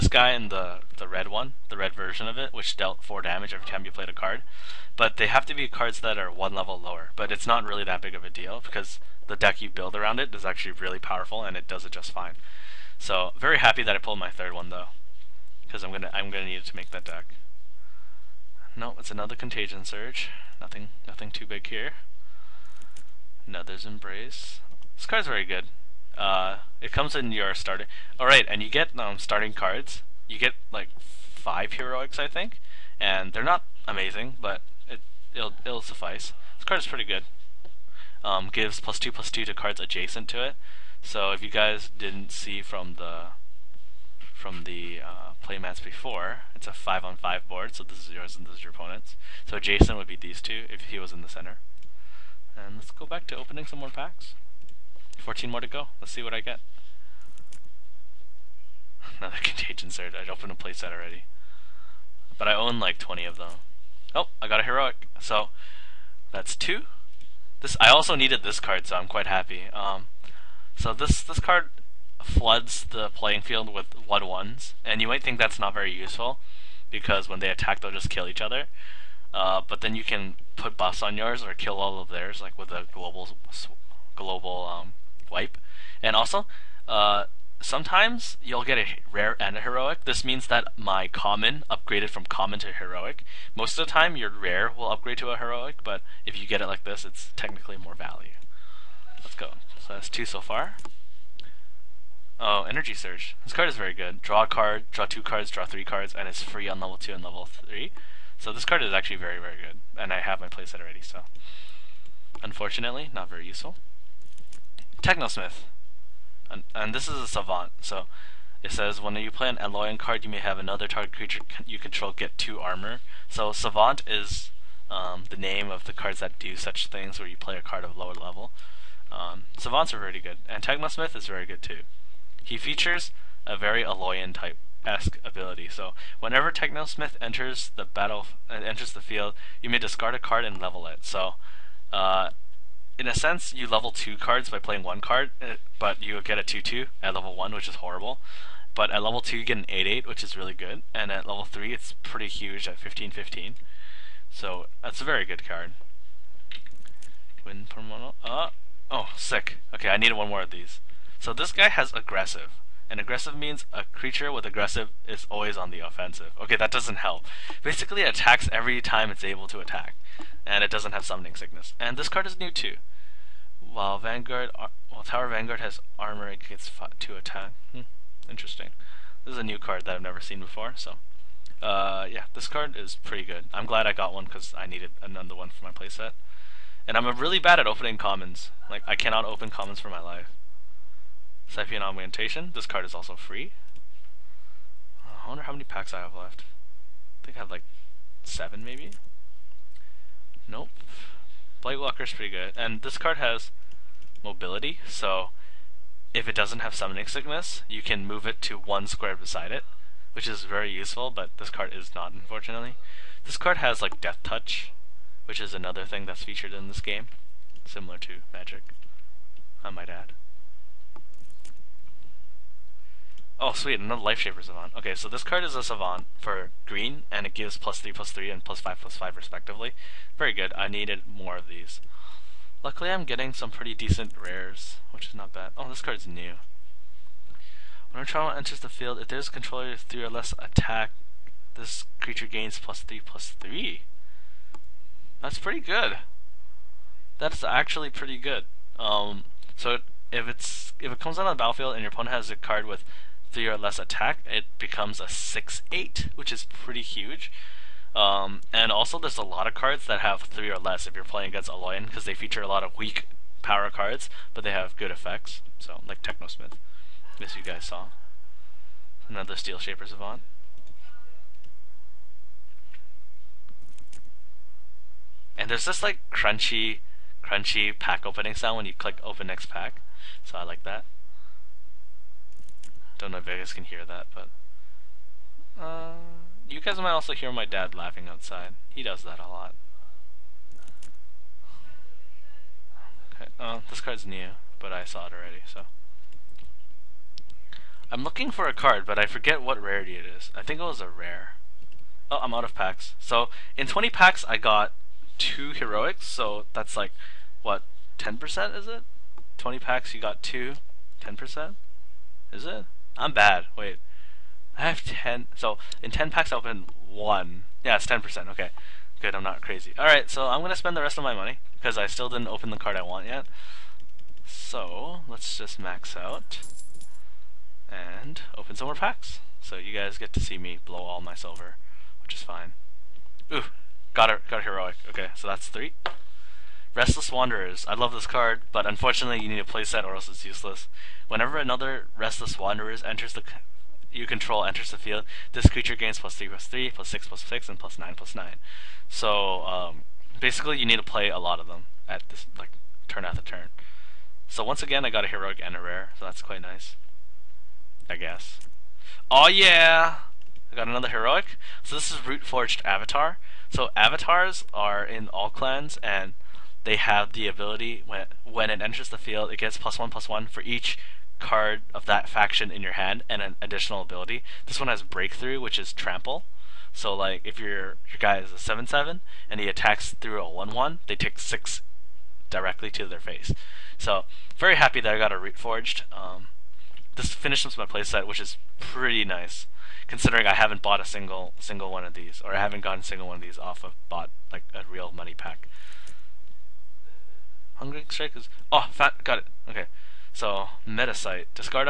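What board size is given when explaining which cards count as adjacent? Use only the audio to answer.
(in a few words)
5 on 5.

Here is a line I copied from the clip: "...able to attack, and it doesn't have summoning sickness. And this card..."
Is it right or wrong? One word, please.
right.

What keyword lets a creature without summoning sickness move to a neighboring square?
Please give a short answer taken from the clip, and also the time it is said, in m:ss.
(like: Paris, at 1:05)
mobility, at 3:24.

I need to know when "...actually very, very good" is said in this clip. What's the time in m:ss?
1:48.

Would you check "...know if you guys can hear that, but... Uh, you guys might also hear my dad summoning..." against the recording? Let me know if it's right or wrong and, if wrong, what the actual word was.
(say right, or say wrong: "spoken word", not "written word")
wrong: "laughing", not "summoning".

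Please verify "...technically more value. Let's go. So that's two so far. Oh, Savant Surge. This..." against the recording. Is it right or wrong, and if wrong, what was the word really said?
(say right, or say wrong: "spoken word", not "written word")
wrong: "Energy", not "Savant".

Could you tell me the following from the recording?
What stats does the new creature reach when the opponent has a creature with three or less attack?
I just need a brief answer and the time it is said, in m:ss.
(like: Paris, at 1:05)
6 8, at 4:15.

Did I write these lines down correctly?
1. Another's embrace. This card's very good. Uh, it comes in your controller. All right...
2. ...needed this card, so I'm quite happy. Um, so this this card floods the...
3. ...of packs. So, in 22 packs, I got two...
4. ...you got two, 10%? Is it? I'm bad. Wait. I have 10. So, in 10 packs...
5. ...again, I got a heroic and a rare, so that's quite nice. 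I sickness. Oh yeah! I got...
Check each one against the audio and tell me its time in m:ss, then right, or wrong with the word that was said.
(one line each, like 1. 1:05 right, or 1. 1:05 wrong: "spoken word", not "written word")
1. 0:23 wrong: "starter", not "controller"
2. 1:08 right
3. 5:02 wrong: "20", not "22"
4. 5:09 right
5. 5:54 wrong: "guess", not "sickness".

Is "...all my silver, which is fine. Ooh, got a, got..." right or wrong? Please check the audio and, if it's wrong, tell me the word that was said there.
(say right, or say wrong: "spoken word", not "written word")
right.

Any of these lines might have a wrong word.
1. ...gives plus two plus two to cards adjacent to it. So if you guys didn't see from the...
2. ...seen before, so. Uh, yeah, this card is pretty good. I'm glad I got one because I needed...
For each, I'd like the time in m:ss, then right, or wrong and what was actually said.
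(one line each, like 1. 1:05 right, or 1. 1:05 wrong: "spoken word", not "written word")
1. 0:38 right
2. 3:00 right.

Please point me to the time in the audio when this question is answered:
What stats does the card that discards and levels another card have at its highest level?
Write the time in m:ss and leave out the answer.
2:32.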